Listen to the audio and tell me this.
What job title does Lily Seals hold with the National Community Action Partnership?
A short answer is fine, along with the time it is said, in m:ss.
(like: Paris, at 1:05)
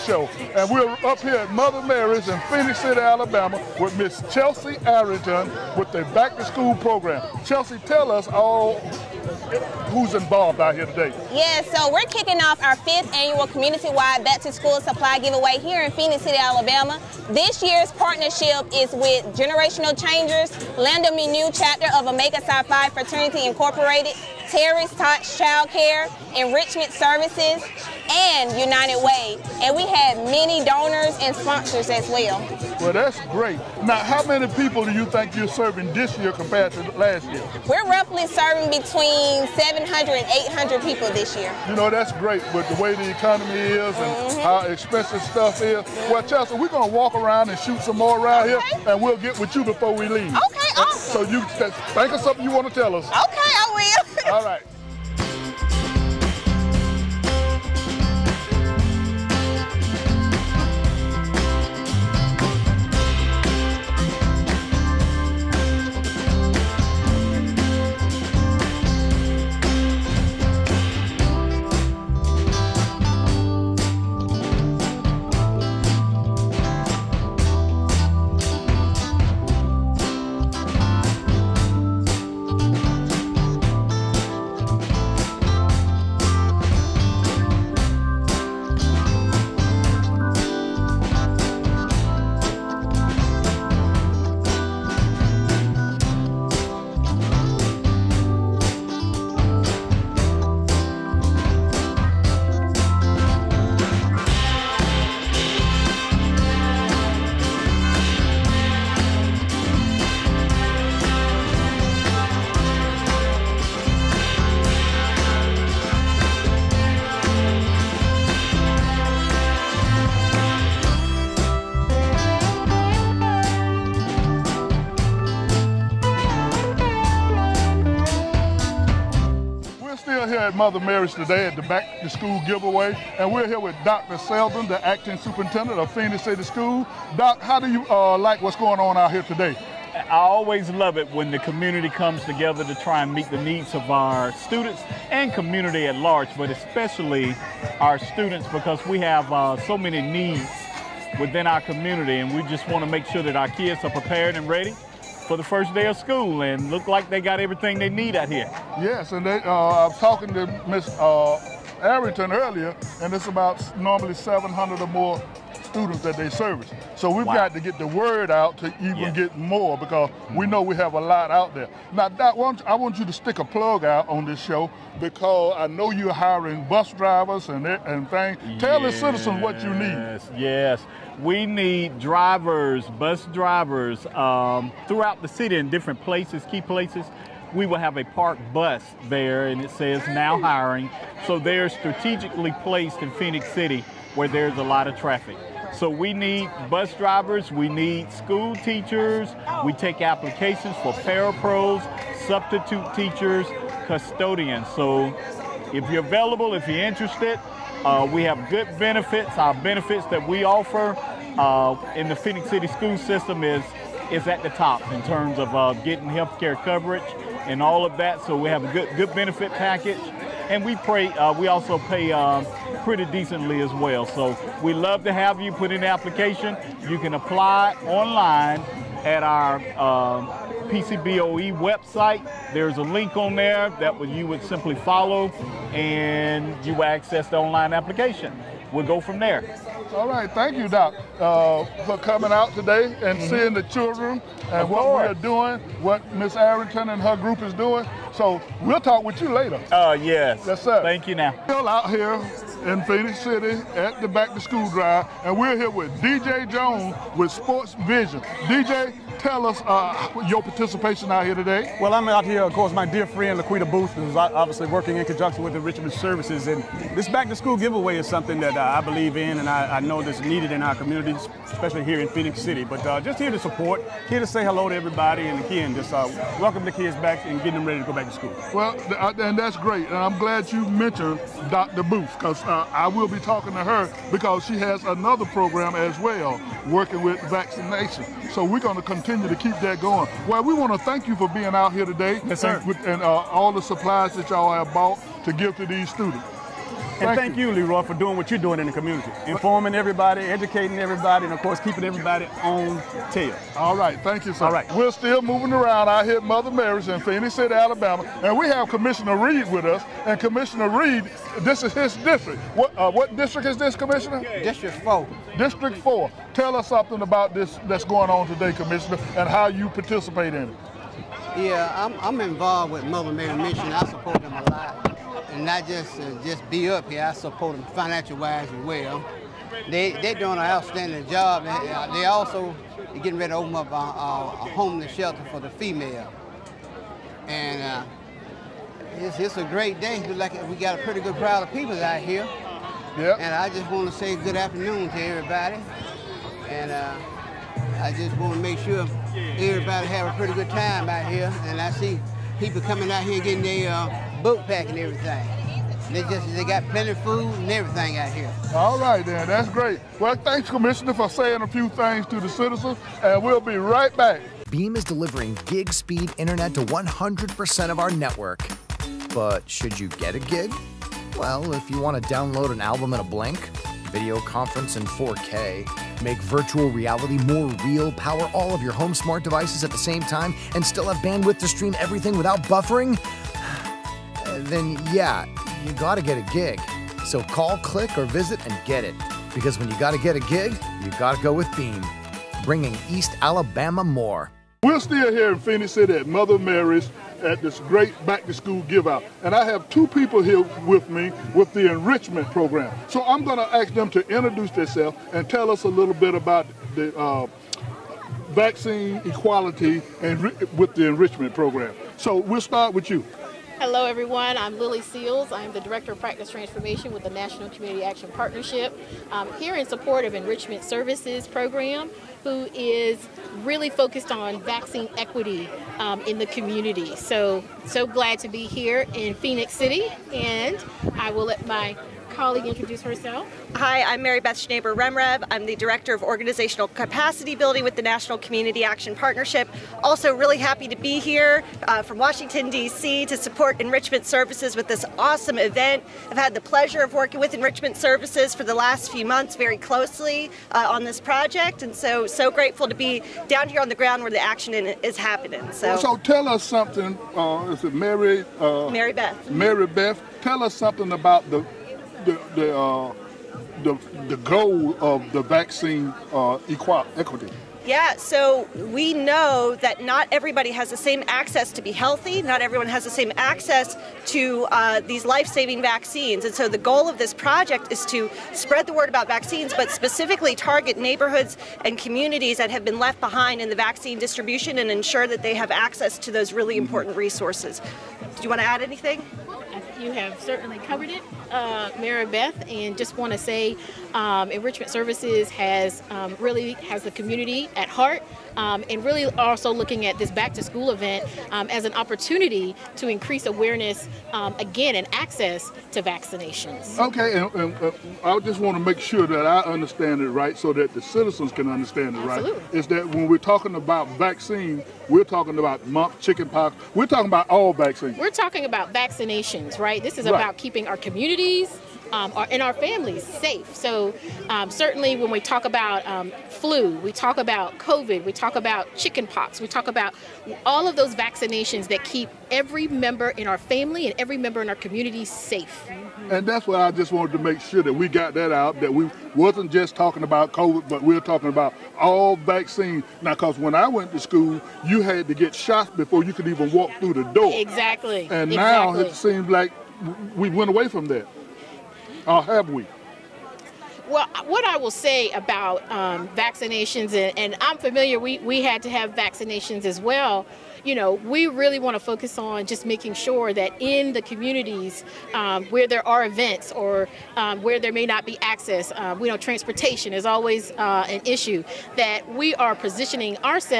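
Director of Practice Transformation, at 6:55.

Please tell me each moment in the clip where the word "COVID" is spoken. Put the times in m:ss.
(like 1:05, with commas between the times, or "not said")
8:47, 9:00.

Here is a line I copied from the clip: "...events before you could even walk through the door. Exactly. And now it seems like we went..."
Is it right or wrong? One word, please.
wrong.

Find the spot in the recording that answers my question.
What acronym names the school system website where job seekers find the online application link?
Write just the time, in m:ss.
3:50.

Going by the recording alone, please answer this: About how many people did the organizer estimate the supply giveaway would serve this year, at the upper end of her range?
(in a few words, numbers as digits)
800.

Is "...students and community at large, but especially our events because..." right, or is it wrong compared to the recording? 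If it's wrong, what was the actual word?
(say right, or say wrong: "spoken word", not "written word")
wrong: "students", not "events".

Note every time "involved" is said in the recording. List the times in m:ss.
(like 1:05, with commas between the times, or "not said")
0:10, 5:22.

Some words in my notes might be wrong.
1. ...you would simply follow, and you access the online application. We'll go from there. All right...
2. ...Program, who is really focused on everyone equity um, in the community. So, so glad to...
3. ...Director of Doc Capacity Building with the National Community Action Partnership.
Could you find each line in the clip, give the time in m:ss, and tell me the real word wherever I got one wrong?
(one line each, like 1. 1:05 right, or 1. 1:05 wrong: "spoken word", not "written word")
1. 3:54 right
2. 7:01 wrong: "vaccine", not "everyone"
3. 7:15 wrong: "Organizational", not "Doc".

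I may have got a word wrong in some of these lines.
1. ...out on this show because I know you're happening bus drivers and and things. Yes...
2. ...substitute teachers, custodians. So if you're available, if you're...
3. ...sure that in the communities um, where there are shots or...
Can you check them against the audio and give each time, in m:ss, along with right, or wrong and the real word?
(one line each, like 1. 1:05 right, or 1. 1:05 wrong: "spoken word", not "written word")
1. 2:53 wrong: "hiring", not "happening"
2. 3:22 right
3. 9:22 wrong: "events", not "shots".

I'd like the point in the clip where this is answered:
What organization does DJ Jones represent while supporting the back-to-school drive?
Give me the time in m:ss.
4:17.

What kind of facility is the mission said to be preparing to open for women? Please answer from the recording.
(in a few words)
Homeless shelter.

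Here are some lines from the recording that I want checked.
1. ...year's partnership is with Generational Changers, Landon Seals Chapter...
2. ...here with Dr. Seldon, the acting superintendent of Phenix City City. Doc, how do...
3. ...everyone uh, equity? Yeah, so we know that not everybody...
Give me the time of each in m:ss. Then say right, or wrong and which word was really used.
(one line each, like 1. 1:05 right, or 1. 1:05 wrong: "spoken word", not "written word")
1. 0:17 wrong: "New", not "Seals"
2. 2:13 wrong: "School", not "City"
3. 7:45 wrong: "vaccine", not "everyone".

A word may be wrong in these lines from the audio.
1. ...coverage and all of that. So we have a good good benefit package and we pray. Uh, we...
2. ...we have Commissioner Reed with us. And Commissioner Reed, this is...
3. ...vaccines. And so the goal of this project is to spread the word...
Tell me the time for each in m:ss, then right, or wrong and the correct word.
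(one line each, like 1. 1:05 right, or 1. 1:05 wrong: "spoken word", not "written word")
1. 3:36 right
2. 5:08 right
3. 7:55 right.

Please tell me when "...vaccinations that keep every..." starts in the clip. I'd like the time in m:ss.
8:50.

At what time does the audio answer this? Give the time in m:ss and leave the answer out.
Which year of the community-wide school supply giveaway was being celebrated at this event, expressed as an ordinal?
0:12.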